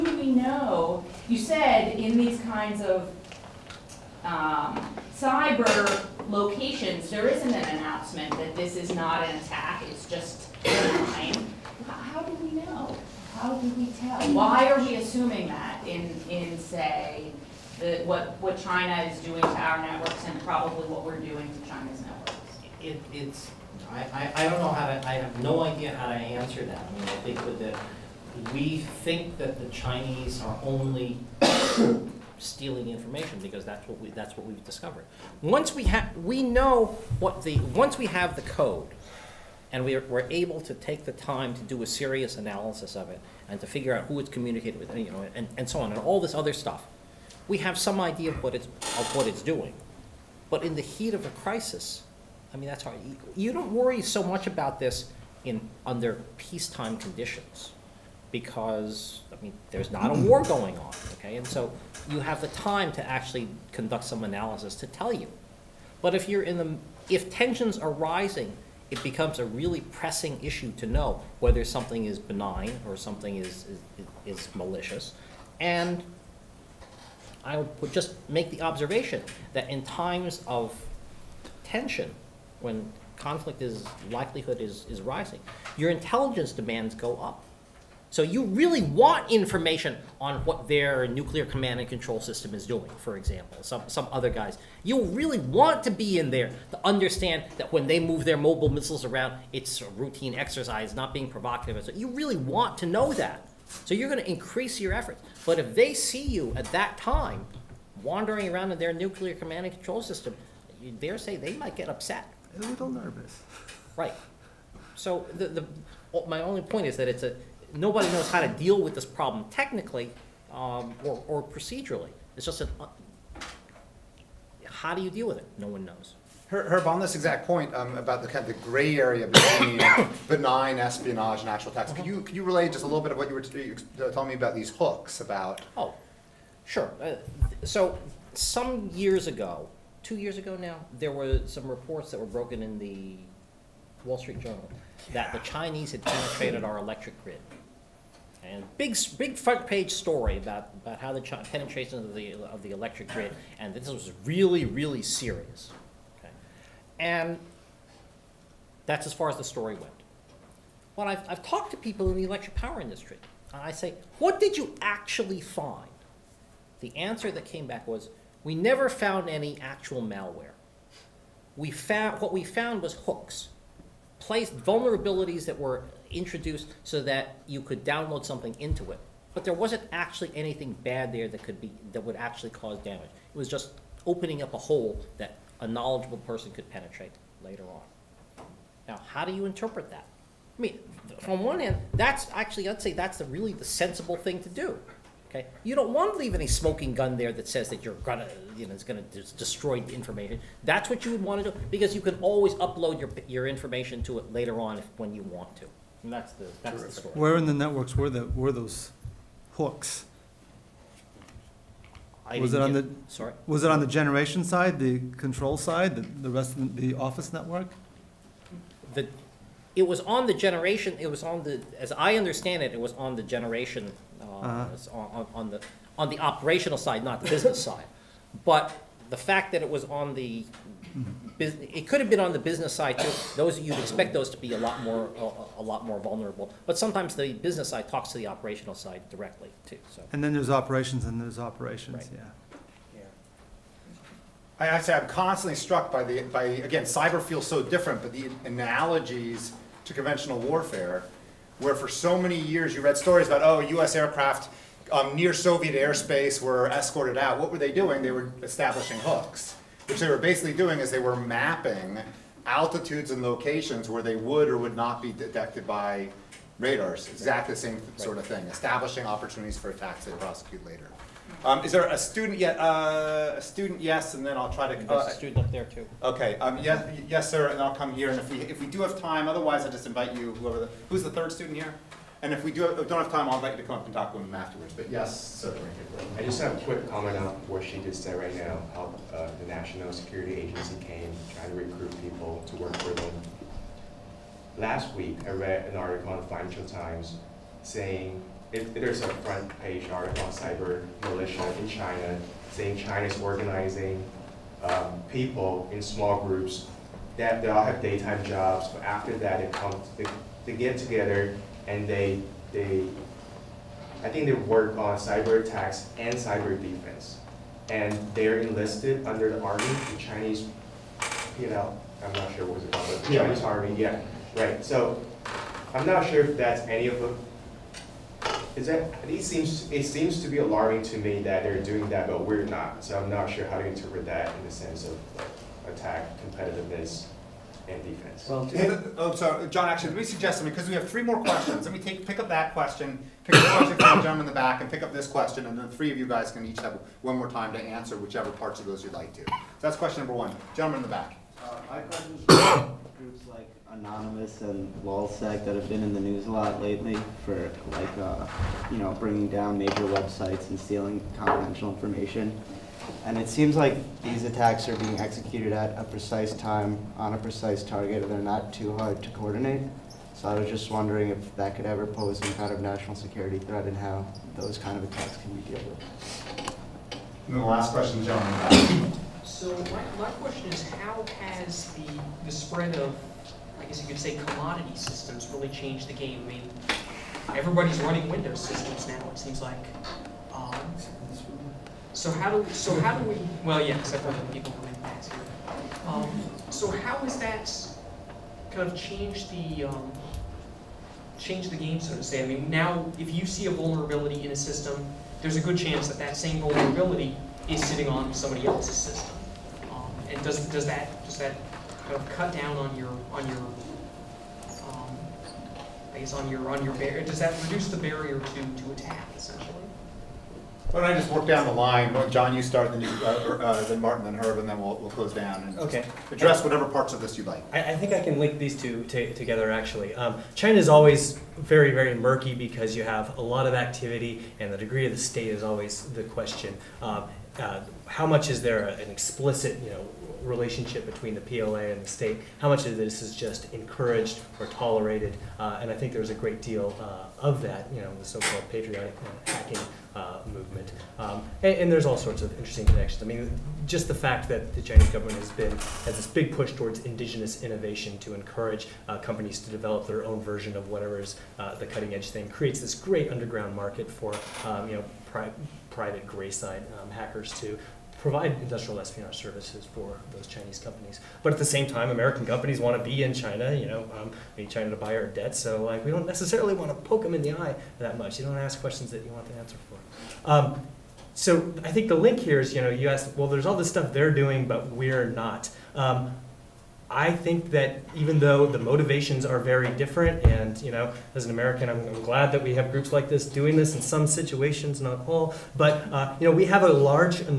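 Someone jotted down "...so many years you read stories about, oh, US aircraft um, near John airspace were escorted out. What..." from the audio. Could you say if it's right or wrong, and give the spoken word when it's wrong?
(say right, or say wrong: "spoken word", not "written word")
wrong: "Soviet", not "John".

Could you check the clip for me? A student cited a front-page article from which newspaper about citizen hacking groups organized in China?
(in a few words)
Financial Times.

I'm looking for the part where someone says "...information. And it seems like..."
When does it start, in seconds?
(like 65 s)
361 s.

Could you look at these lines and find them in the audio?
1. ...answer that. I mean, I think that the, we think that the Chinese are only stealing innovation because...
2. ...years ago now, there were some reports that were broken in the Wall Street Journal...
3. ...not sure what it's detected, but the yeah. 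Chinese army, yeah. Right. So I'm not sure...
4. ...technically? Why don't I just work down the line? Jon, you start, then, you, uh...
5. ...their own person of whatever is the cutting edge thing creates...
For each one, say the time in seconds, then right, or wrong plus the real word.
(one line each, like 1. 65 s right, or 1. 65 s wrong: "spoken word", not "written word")
1. 26 s wrong: "information", not "innovation"
2. 140 s right
3. 322 s wrong: "called", not "detected"
4. 419 s wrong: "essentially", not "technically"
5. 459 s wrong: "version", not "person".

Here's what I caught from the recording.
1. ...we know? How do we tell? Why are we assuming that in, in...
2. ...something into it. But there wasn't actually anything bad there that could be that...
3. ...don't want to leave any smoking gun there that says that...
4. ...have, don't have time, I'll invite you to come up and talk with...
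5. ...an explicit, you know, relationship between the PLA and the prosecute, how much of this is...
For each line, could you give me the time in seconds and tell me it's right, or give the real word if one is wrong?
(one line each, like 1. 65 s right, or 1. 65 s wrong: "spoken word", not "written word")
1. 12 s right
2. 178 s right
3. 195 s right
4. 282 s right
5. 438 s wrong: "state", not "prosecute".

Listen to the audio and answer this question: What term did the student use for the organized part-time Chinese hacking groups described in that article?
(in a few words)
cyber militia.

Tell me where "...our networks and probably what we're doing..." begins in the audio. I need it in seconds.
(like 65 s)
19 s.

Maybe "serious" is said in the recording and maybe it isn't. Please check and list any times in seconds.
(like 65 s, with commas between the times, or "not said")
41 s, 155 s.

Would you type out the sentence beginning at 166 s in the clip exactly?
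The answer that came back was, we never found any actual malware.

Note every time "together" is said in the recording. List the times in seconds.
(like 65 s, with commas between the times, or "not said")
310 s, 428 s.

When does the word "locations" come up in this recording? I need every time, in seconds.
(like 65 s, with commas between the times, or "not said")
6 s, 263 s.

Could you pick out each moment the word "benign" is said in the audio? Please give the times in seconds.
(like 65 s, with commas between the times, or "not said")
72 s, 130 s.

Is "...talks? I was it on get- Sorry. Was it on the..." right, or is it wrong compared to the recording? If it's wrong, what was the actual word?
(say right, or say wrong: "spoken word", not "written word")
wrong: "hooks", not "talks".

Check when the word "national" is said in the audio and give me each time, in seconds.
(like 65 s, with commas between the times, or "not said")
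289 s, 372 s.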